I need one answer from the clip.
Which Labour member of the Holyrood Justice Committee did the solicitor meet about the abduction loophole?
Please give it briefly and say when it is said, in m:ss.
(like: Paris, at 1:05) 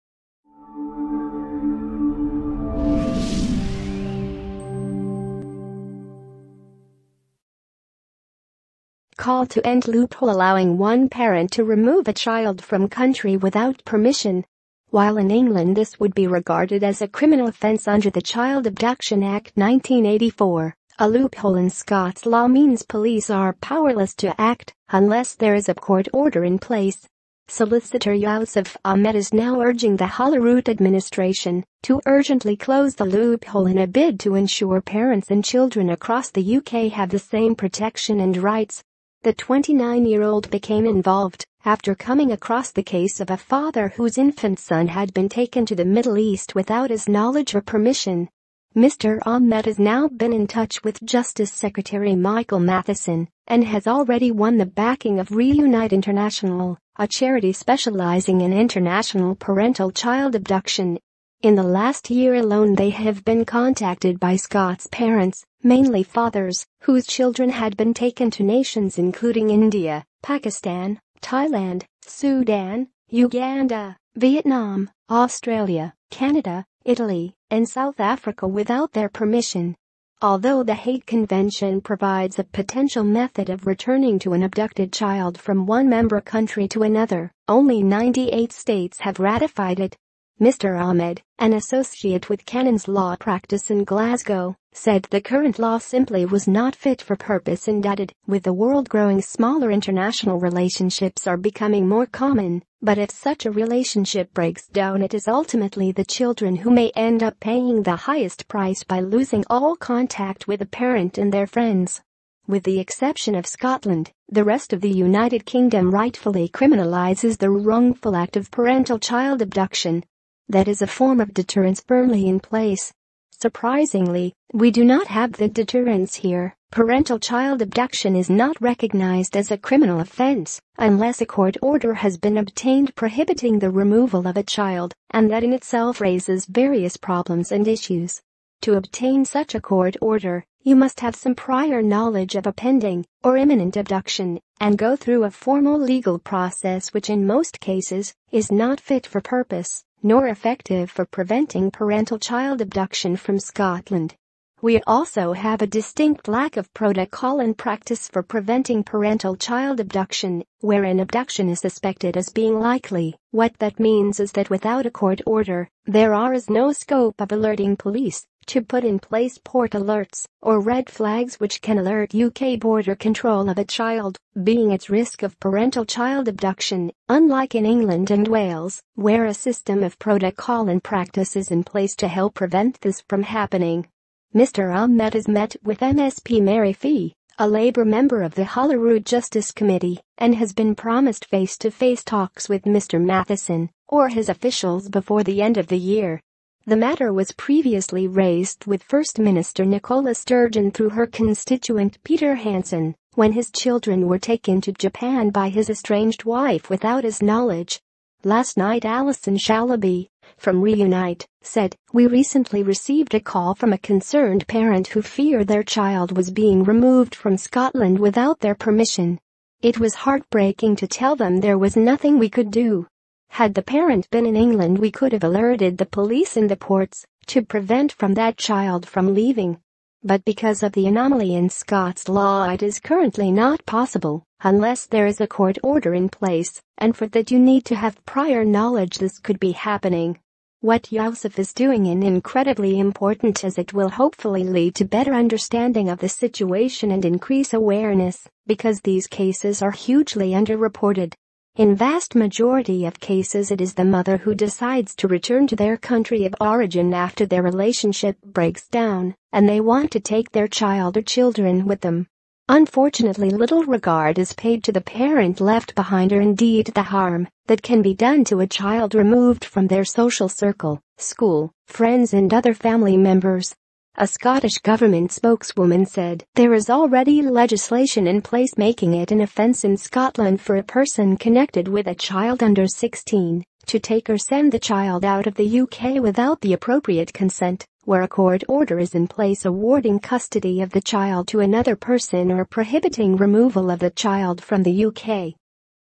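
Mary Fee, at 3:06.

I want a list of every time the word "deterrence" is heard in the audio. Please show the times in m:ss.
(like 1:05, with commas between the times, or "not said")
2:01, 2:05.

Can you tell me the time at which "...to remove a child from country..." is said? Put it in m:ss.
0:11.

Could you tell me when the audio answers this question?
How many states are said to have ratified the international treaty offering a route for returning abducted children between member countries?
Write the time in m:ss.
1:27.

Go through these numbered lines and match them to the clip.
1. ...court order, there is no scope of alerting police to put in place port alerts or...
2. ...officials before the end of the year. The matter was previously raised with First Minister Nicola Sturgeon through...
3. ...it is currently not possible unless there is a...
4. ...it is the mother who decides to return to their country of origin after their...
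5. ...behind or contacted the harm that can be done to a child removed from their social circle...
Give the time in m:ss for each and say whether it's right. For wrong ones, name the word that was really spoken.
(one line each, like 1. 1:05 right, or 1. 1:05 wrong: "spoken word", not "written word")
1. 2:44 right
2. 3:14 right
3. 3:52 right
4. 4:13 right
5. 4:25 wrong: "indeed", not "contacted".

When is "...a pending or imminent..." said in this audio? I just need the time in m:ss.
2:22.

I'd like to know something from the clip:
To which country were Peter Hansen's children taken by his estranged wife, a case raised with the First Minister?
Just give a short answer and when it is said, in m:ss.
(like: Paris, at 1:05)
Japan, at 3:24.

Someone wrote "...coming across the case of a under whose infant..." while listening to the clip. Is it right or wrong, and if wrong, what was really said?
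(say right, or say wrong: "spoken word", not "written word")
wrong: "father", not "under".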